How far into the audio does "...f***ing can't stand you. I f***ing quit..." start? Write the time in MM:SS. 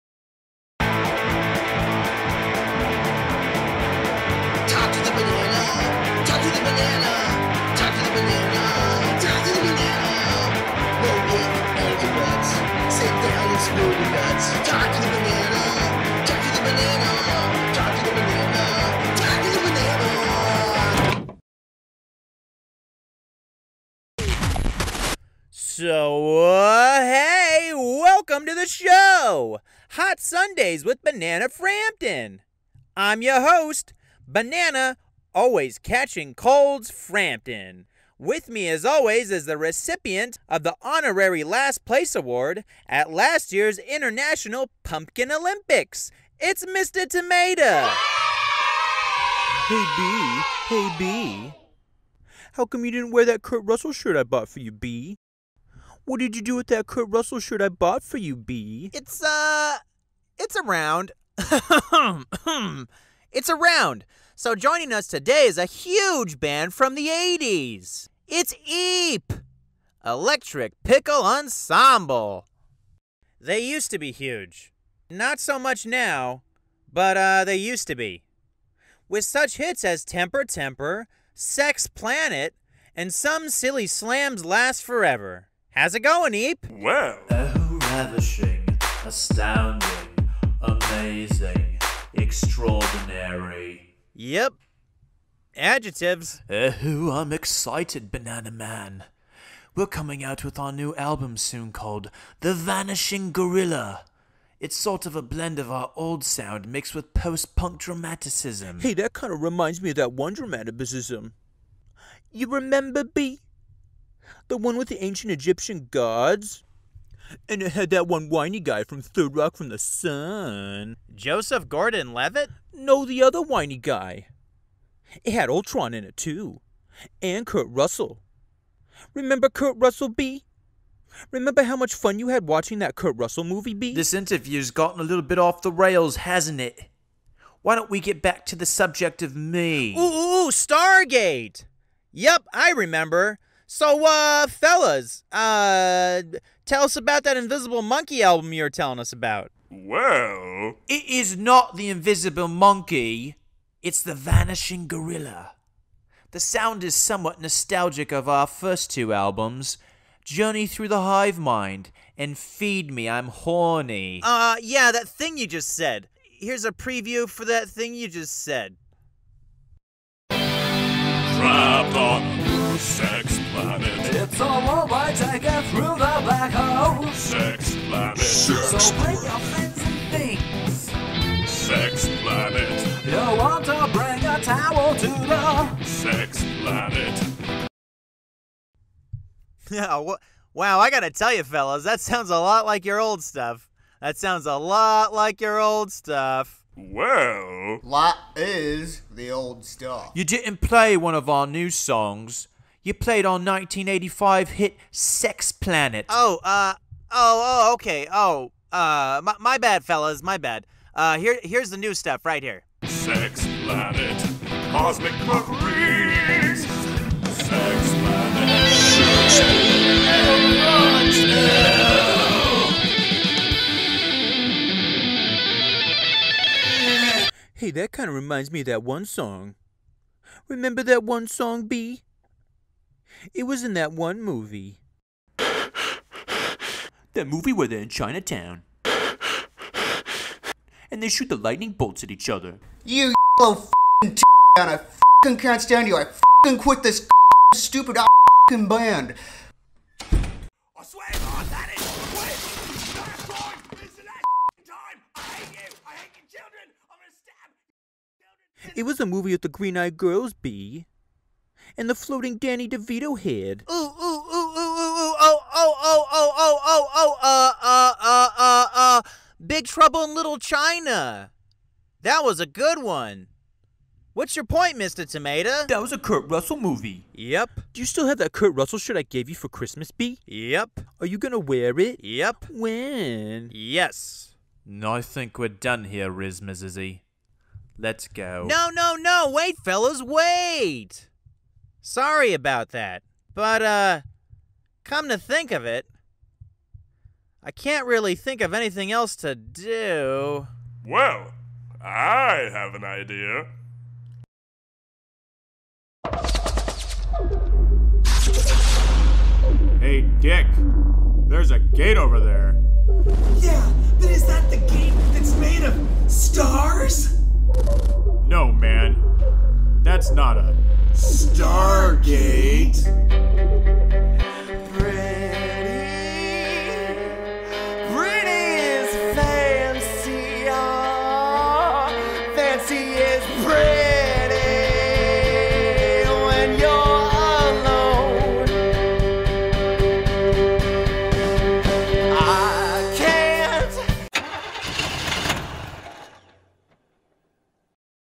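04:04.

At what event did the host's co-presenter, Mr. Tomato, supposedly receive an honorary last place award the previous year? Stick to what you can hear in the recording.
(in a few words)
International Pumpkin Olympics.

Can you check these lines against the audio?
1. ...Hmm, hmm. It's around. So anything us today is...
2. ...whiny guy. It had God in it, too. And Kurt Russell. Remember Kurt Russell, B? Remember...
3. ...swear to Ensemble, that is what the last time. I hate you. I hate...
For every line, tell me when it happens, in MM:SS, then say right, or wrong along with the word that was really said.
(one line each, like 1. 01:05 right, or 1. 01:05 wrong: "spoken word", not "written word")
1. 01:01 wrong: "joining", not "anything"
2. 02:03 wrong: "Ultron", not "God"
3. 04:10 wrong: "God", not "Ensemble".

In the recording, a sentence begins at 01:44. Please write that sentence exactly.
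It's sort of a blend of our old sound mixed with post punk dramaticism.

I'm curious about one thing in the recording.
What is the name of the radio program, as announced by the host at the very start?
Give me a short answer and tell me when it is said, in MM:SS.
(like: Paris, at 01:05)
Hot Sundays, at 00:29.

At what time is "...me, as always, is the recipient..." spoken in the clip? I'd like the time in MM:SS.
00:38.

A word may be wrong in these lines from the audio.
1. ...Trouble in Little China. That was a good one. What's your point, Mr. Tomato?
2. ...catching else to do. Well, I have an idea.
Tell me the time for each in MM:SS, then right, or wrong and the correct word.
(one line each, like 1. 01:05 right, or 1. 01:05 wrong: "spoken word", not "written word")
1. 04:29 right
2. 04:58 wrong: "anything", not "catching".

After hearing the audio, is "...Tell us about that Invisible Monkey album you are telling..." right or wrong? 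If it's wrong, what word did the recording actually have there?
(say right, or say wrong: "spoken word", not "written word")
right.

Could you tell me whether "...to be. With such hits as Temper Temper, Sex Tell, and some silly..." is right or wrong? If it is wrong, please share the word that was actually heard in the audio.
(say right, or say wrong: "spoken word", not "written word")
wrong: "Planet", not "Tell".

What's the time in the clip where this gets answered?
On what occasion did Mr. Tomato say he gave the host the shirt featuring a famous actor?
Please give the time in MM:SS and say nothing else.
04:39.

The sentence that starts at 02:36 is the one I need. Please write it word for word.
The sound is somewhat nostalgic of our first two albums, Journey Through the Hive Mind and Feed Me, I'm Horny.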